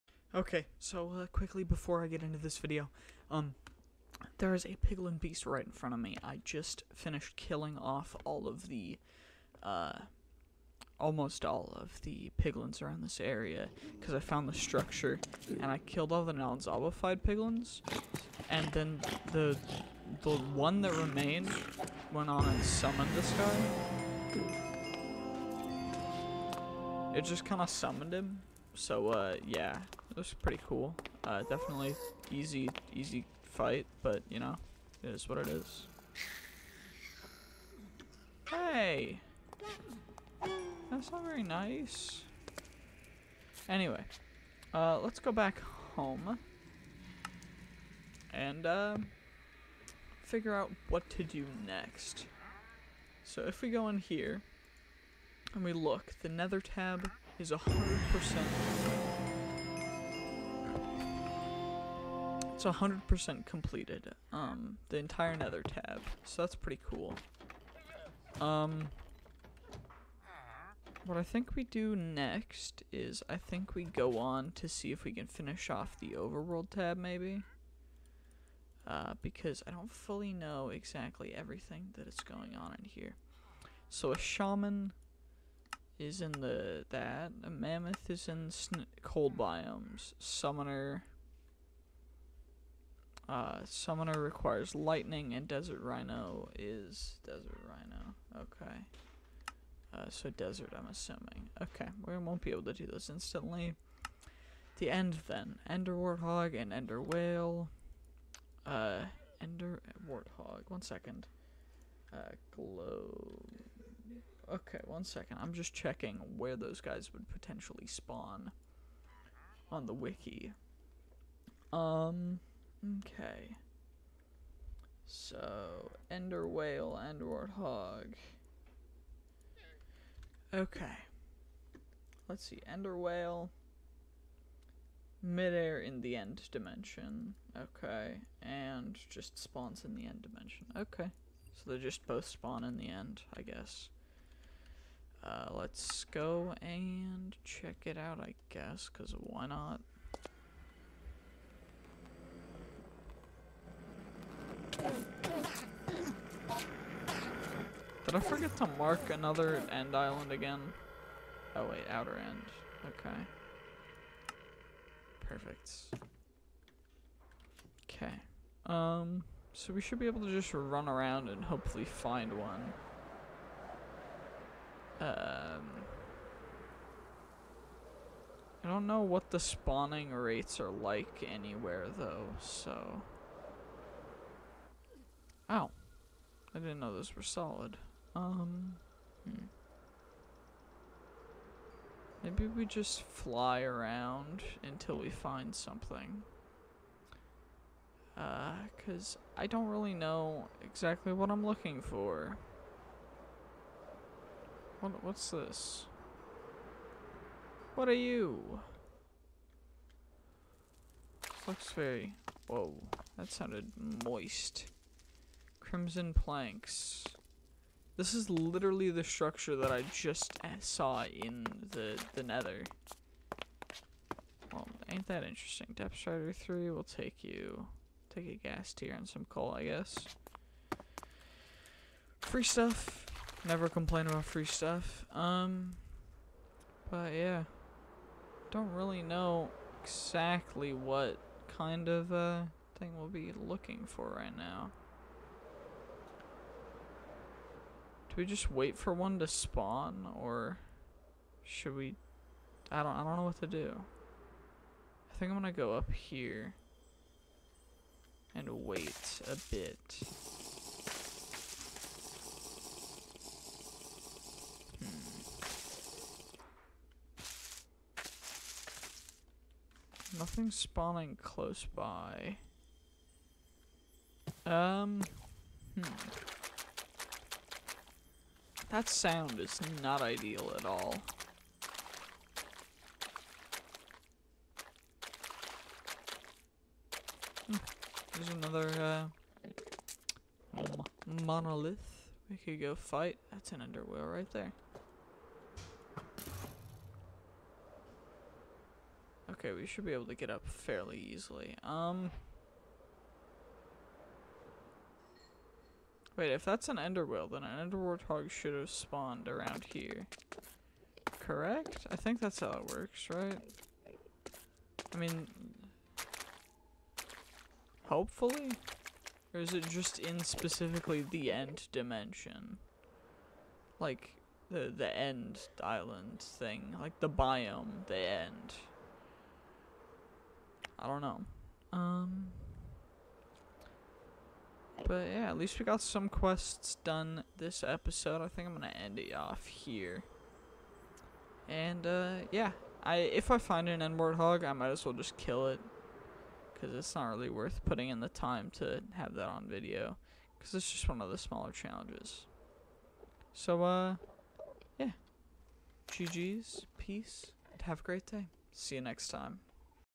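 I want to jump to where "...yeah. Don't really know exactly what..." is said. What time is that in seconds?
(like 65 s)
237 s.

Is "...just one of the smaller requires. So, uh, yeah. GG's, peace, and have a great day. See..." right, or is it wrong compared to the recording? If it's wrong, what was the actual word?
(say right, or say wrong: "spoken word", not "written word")
wrong: "challenges", not "requires".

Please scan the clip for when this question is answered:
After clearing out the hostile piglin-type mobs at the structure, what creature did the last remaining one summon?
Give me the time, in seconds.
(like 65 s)
4 s.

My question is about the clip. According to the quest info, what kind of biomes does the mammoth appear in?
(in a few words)
cold biomes.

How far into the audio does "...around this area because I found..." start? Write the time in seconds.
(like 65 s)
12 s.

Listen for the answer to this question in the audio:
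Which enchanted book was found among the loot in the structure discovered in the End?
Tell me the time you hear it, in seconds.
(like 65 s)
225 s.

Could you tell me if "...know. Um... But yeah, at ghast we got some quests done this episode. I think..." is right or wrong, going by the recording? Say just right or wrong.
wrong.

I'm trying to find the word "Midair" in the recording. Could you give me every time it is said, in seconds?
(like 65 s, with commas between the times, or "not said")
135 s.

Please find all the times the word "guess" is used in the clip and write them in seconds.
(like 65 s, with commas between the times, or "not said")
143 s, 148 s, 229 s.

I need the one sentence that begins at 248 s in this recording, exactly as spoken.
Do we just wait for one to spawn or should we I don't I don't know what to do.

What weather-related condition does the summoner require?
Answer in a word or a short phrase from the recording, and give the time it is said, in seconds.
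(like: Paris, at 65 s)
lightning, at 94 s.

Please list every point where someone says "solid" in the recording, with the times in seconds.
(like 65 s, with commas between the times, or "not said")
187 s.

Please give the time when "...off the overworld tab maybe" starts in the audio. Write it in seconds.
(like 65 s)
75 s.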